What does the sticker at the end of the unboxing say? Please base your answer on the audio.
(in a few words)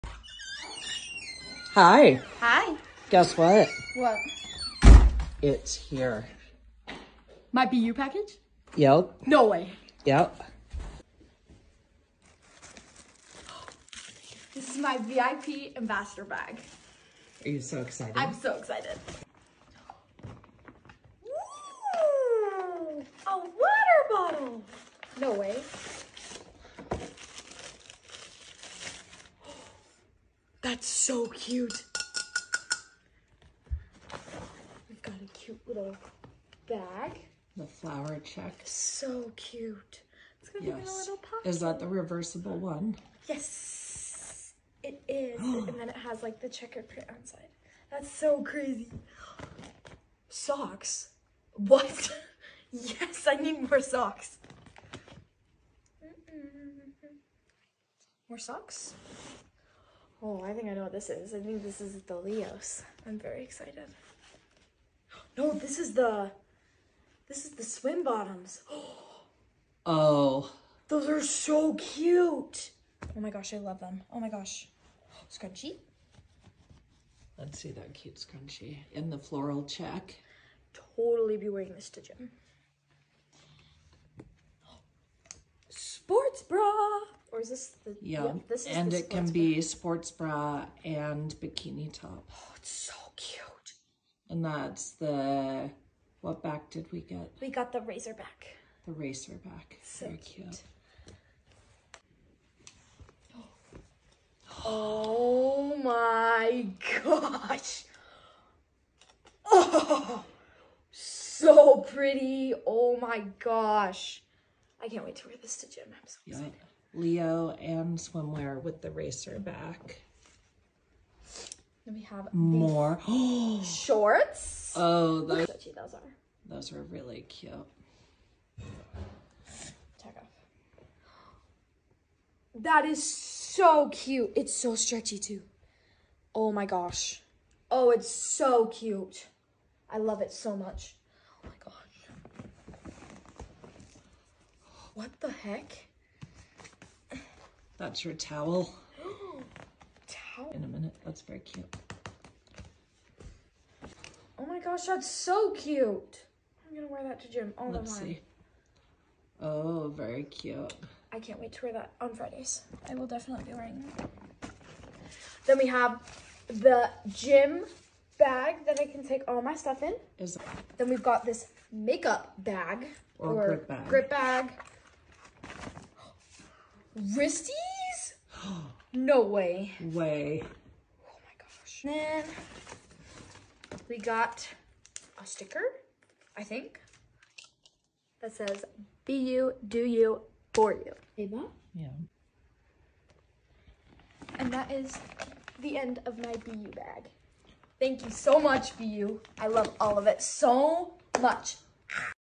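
be you, do you, for you.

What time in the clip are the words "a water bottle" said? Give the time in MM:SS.
00:23.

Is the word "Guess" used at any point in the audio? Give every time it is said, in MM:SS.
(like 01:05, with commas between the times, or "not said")
00:03.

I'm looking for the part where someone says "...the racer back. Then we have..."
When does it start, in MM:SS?
01:58.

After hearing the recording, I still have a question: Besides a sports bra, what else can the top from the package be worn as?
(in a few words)
bikini top.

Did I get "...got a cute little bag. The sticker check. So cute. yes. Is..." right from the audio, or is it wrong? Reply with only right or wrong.
wrong.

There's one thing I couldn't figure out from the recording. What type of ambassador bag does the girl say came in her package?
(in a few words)
VIP ambassador bag.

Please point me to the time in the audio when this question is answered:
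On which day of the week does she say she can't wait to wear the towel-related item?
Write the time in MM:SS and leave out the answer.
02:42.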